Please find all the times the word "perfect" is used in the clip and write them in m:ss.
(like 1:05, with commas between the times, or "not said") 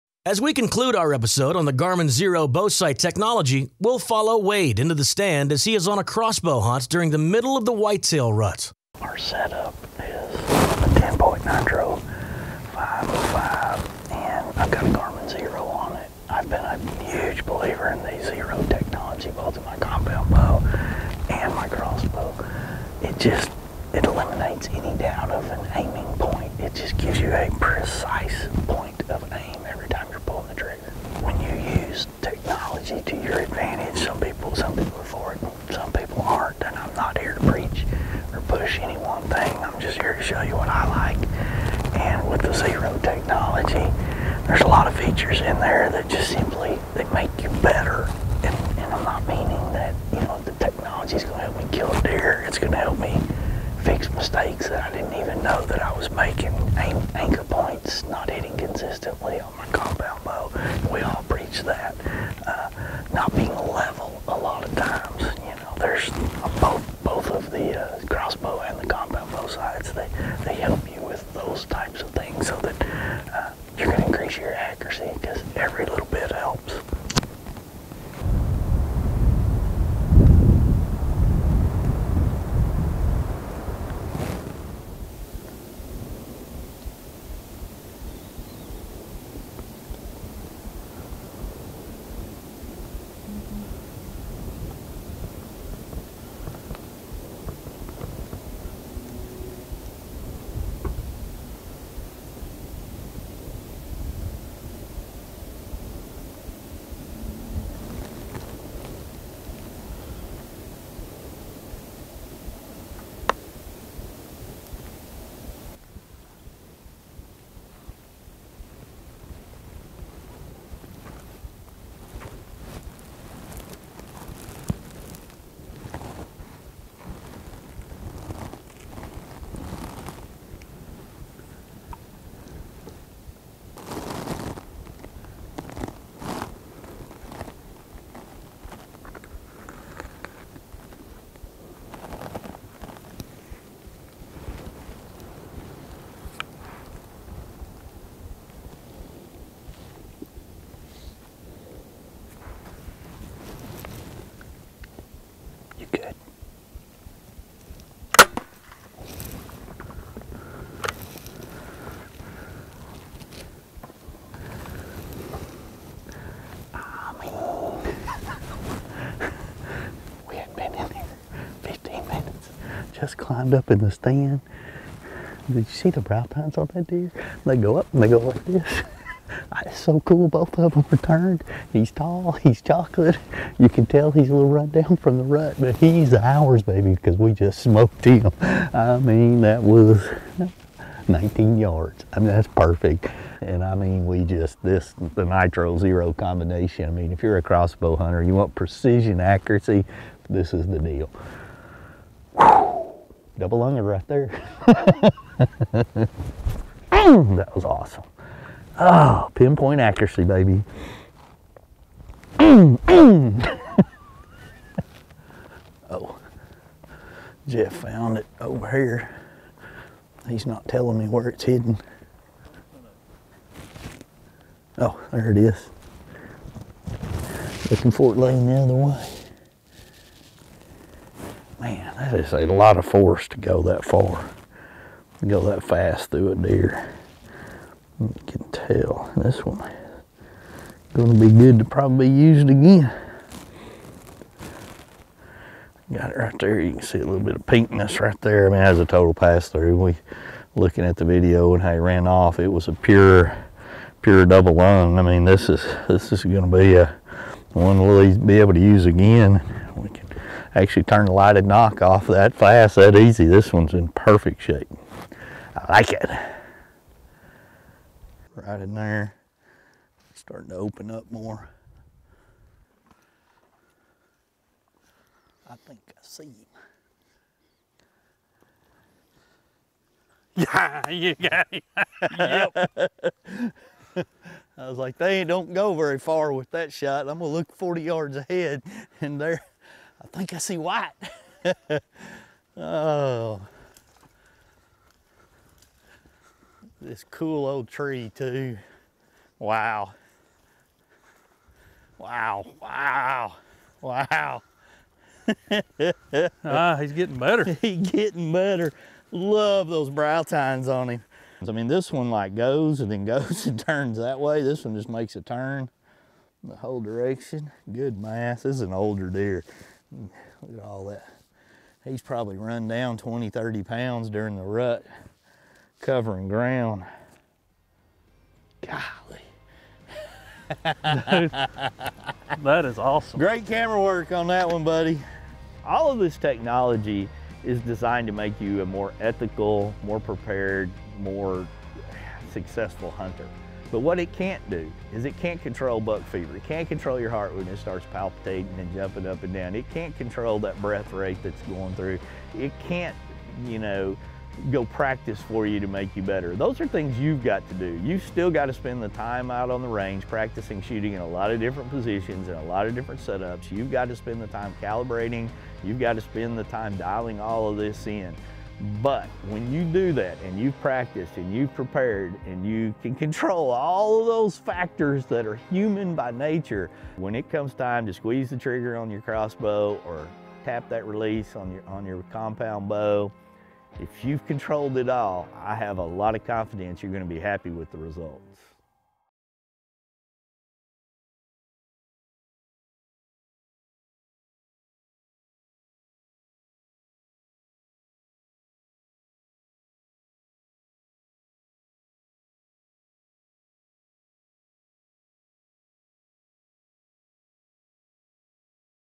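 3:12, 4:23.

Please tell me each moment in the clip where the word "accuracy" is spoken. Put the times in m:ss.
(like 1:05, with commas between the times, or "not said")
3:19, 3:29.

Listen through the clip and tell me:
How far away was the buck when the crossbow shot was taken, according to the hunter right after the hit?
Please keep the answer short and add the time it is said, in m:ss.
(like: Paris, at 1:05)
19 yards, at 3:11.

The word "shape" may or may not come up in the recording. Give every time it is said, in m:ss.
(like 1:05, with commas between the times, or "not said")
4:24.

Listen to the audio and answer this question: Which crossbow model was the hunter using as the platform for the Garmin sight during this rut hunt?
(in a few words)
TenPoint Nitro 505.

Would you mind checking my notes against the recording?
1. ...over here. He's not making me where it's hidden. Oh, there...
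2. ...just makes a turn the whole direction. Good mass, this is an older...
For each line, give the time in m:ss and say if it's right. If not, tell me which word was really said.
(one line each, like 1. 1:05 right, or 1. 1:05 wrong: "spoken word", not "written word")
1. 3:38 wrong: "telling", not "making"
2. 5:14 right.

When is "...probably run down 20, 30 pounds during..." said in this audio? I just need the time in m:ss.
5:22.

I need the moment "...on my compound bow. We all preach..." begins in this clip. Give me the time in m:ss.
0:59.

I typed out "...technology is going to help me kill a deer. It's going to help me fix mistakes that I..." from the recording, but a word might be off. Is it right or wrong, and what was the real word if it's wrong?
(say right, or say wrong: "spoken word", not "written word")
right.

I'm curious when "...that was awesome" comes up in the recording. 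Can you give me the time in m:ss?
3:26.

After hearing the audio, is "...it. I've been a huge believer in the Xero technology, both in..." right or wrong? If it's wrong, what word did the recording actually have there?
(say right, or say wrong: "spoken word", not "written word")
right.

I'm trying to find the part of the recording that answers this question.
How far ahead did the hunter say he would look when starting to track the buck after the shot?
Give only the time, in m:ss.
4:47.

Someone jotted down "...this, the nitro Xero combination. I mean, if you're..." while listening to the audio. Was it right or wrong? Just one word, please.
right.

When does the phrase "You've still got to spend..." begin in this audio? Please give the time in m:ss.
5:57.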